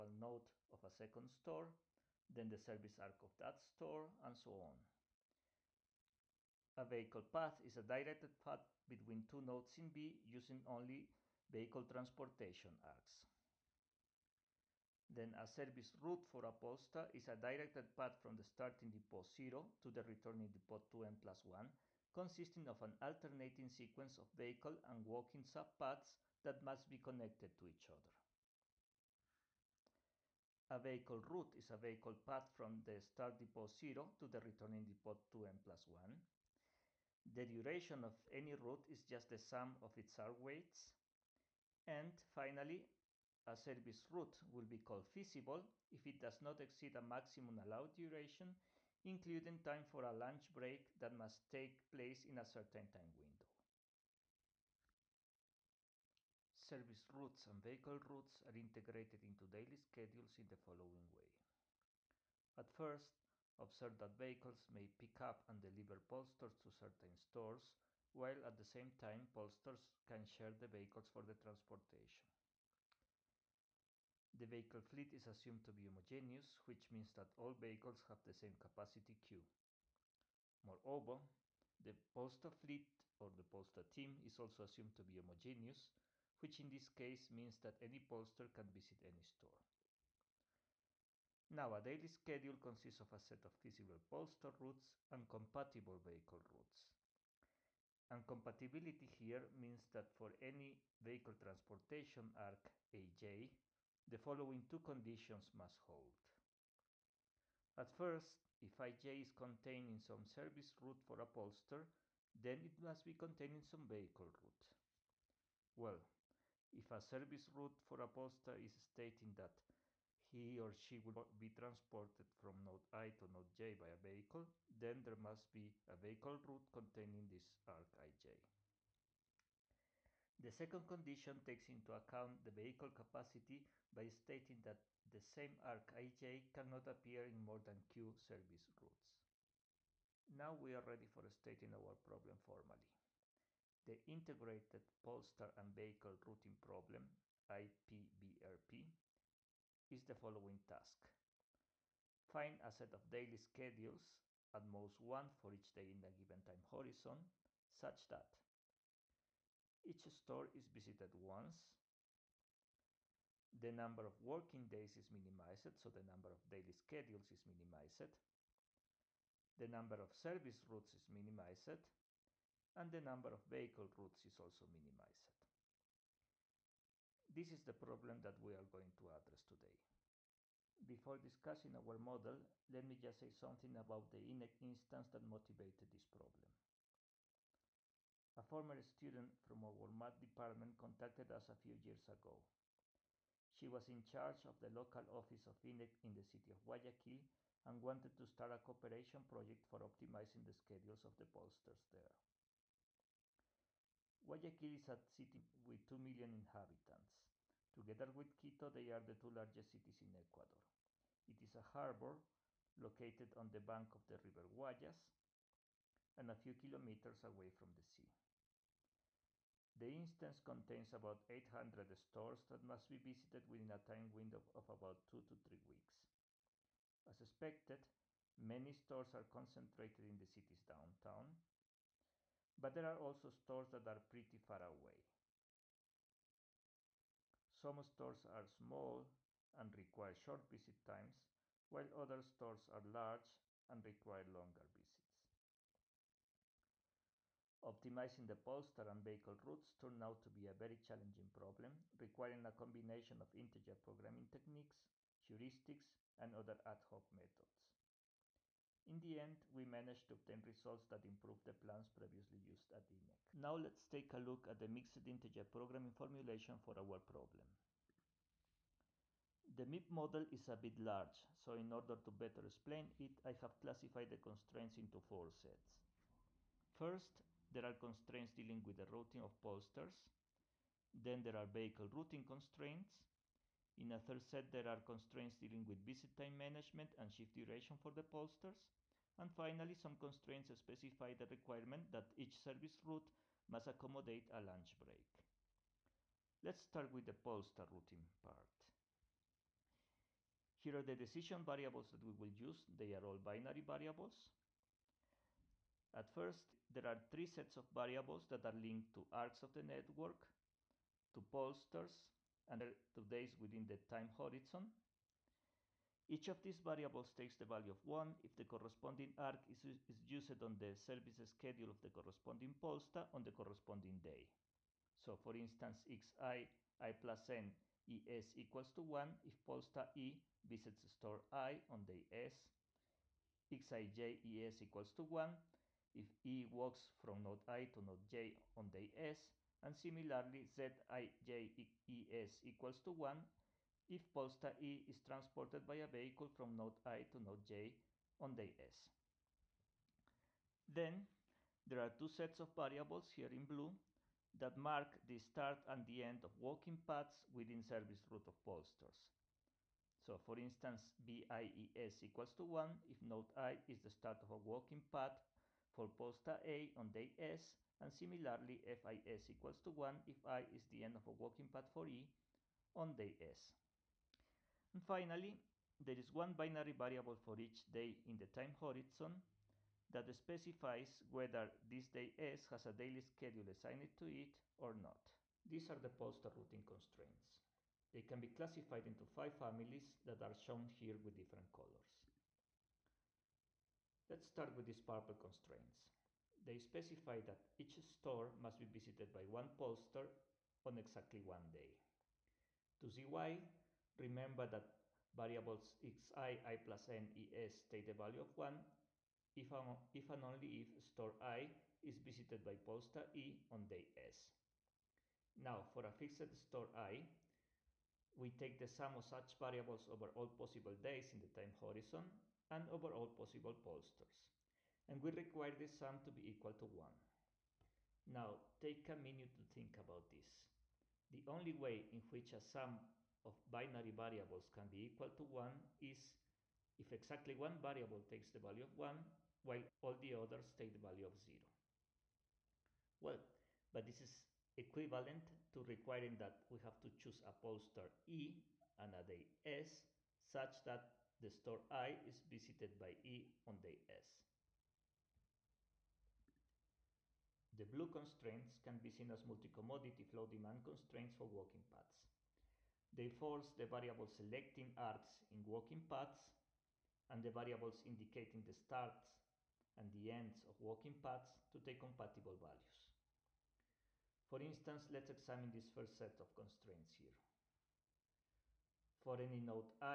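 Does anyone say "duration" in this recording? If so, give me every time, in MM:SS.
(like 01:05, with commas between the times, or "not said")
00:37, 00:47, 04:47.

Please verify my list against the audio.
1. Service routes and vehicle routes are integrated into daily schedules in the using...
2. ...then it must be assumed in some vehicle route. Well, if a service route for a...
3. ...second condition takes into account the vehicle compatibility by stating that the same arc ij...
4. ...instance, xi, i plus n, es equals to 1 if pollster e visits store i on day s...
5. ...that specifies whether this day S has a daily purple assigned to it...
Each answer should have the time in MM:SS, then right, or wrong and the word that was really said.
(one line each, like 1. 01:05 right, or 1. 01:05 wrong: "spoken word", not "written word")
1. 00:56 wrong: "following", not "using"
2. 01:52 wrong: "contained", not "assumed"
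3. 02:10 wrong: "capacity", not "compatibility"
4. 05:25 right
5. 06:19 wrong: "schedule", not "purple".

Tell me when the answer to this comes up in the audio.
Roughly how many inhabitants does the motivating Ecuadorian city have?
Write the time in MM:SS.
03:25.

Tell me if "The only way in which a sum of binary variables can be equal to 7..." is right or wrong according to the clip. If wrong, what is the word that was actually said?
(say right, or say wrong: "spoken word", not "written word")
wrong: "1", not "7".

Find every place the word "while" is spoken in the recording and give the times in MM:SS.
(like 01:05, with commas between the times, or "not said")
01:08, 04:01, 07:19.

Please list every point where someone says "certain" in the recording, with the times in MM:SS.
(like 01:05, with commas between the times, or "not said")
00:52, 01:06.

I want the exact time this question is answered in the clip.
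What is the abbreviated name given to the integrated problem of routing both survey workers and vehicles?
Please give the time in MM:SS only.
02:27.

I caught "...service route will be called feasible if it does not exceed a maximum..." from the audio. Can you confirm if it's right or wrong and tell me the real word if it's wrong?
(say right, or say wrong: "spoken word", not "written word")
right.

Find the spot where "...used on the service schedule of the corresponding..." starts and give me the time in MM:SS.
05:20.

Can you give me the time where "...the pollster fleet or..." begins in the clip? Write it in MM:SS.
01:21.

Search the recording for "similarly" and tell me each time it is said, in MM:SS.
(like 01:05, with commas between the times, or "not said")
05:39, 06:07.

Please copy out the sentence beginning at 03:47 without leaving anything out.
As expected, many stores are concentrated in the city's downtown, but there are also stores that are pretty far away.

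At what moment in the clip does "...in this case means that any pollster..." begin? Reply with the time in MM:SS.
01:26.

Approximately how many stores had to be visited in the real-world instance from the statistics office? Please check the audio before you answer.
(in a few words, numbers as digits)
800.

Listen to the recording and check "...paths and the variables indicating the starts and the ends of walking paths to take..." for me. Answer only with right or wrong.
right.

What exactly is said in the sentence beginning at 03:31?
It is a harbor located on the bank of the river Guayas and a few kilometers away from the sea.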